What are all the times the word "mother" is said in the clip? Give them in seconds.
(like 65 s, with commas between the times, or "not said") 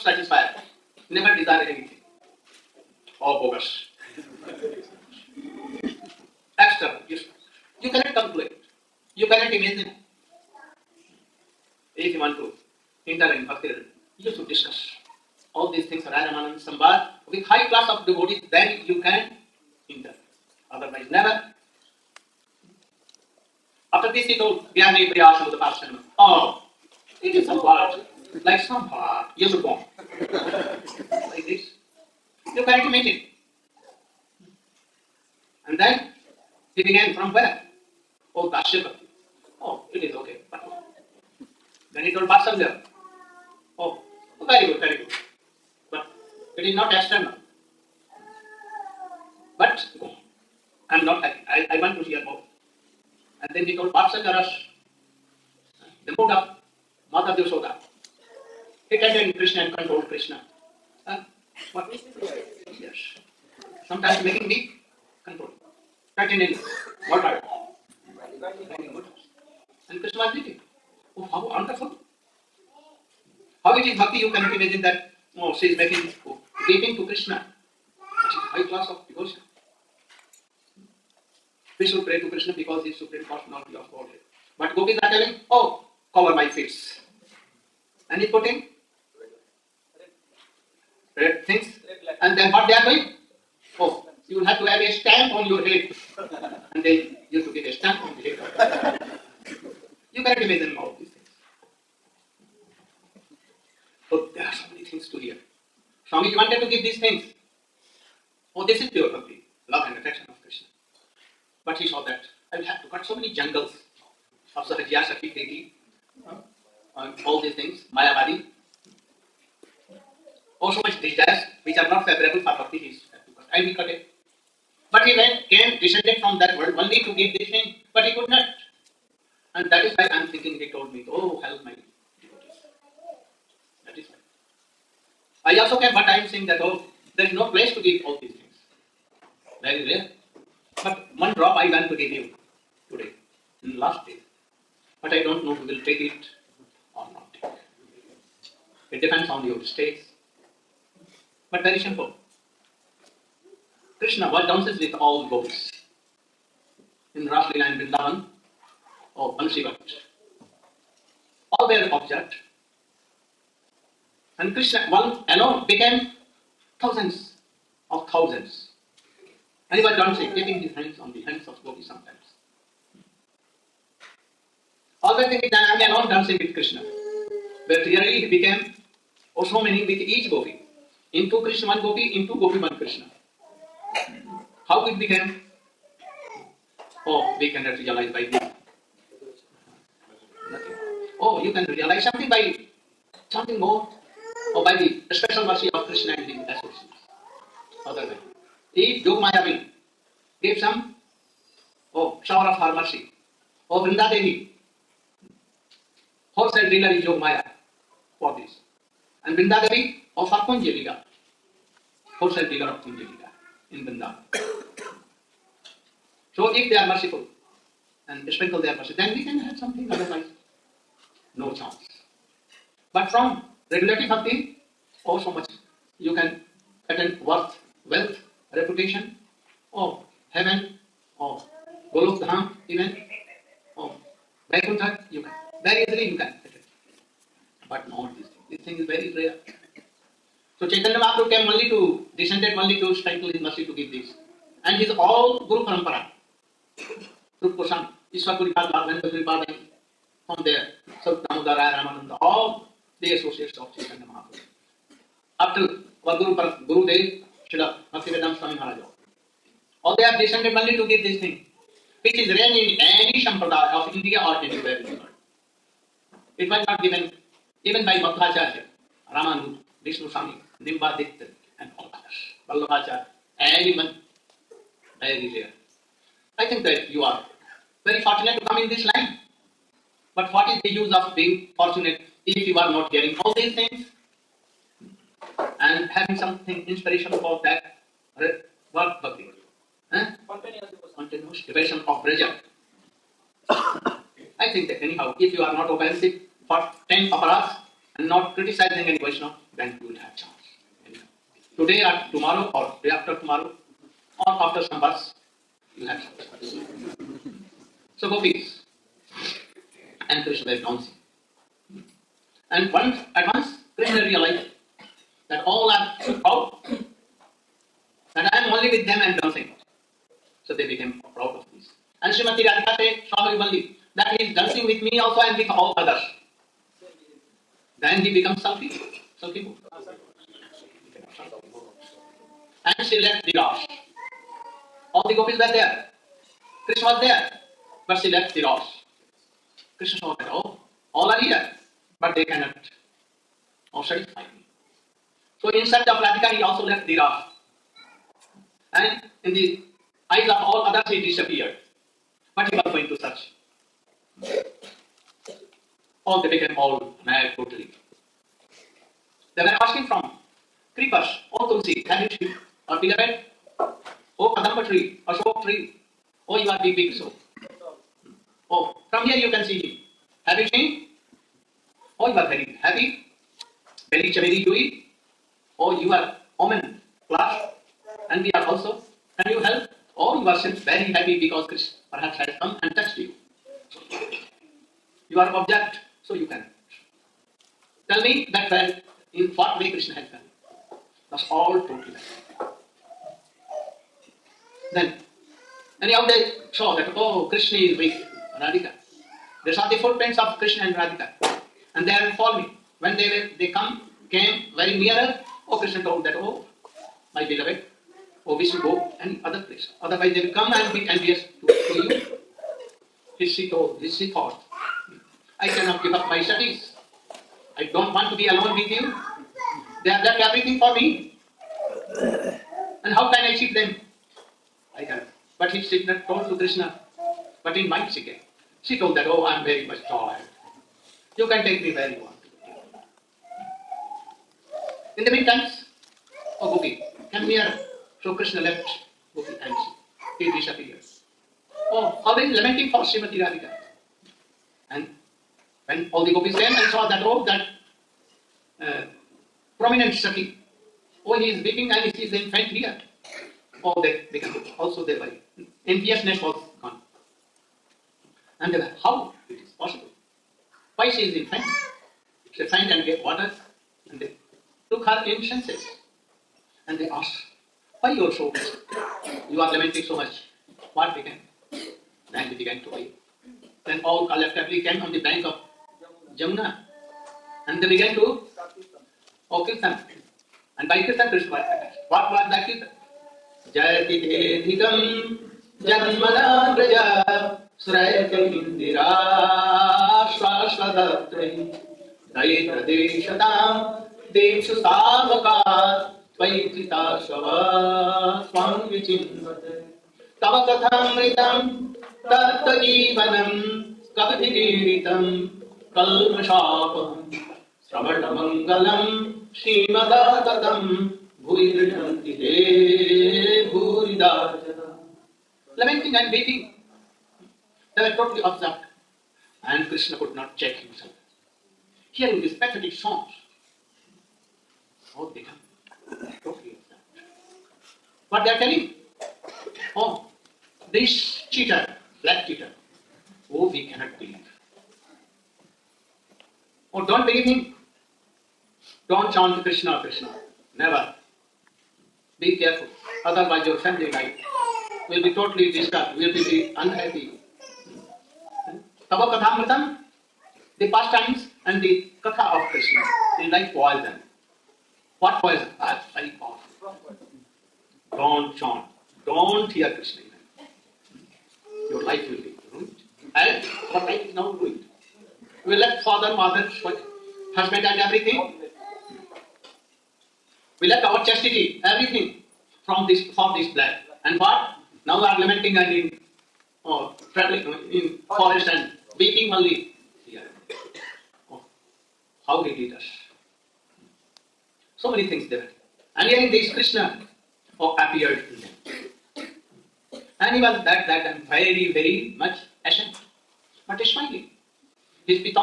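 57 s, 566 s.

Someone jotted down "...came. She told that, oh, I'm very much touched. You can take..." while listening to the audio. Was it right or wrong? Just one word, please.
wrong.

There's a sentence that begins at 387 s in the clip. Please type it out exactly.
Tell me that where in what way Krishna has done.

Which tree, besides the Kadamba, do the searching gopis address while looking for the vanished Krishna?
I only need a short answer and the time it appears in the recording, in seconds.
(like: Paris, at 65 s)
Ashok tree, at 365 s.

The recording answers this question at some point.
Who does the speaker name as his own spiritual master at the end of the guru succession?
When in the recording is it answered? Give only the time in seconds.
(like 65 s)
257 s.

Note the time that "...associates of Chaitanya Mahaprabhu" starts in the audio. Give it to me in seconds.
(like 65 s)
253 s.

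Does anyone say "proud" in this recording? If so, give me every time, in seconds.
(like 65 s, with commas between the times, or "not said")
321 s.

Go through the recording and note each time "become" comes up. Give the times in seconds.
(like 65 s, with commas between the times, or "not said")
328 s, 454 s, 525 s.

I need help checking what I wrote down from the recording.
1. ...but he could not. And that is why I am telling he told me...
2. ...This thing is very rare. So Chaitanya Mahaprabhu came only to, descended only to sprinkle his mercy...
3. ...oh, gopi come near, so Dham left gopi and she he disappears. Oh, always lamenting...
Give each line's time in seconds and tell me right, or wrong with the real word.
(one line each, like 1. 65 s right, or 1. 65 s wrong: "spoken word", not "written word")
1. 127 s wrong: "thinking", not "telling"
2. 238 s right
3. 436 s wrong: "Krishna", not "Dham".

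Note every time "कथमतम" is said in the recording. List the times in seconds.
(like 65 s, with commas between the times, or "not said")
500 s, 549 s.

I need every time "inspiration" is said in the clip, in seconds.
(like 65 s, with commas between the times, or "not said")
286 s.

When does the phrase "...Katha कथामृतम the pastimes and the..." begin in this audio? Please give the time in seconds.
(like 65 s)
549 s.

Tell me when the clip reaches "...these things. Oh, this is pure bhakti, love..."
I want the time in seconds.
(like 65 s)
106 s.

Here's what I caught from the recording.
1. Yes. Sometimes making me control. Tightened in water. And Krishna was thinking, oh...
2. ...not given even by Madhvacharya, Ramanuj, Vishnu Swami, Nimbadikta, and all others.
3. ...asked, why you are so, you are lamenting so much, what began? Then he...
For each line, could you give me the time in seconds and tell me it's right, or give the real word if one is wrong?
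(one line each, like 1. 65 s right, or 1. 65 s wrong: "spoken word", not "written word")
1. 62 s right
2. 266 s right
3. 466 s right.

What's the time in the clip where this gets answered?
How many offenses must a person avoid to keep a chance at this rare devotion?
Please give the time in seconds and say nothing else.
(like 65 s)
296 s.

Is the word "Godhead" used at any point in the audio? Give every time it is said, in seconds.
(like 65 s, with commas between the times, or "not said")
83 s.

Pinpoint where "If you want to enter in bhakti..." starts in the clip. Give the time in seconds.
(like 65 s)
11 s.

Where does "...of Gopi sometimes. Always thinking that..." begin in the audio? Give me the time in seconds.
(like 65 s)
171 s.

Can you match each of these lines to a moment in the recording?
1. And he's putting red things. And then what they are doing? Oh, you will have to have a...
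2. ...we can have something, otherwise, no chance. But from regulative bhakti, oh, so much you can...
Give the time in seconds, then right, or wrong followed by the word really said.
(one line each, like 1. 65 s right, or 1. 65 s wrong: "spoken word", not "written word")
1. 88 s right
2. 219 s right.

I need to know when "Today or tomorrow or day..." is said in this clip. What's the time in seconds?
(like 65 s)
301 s.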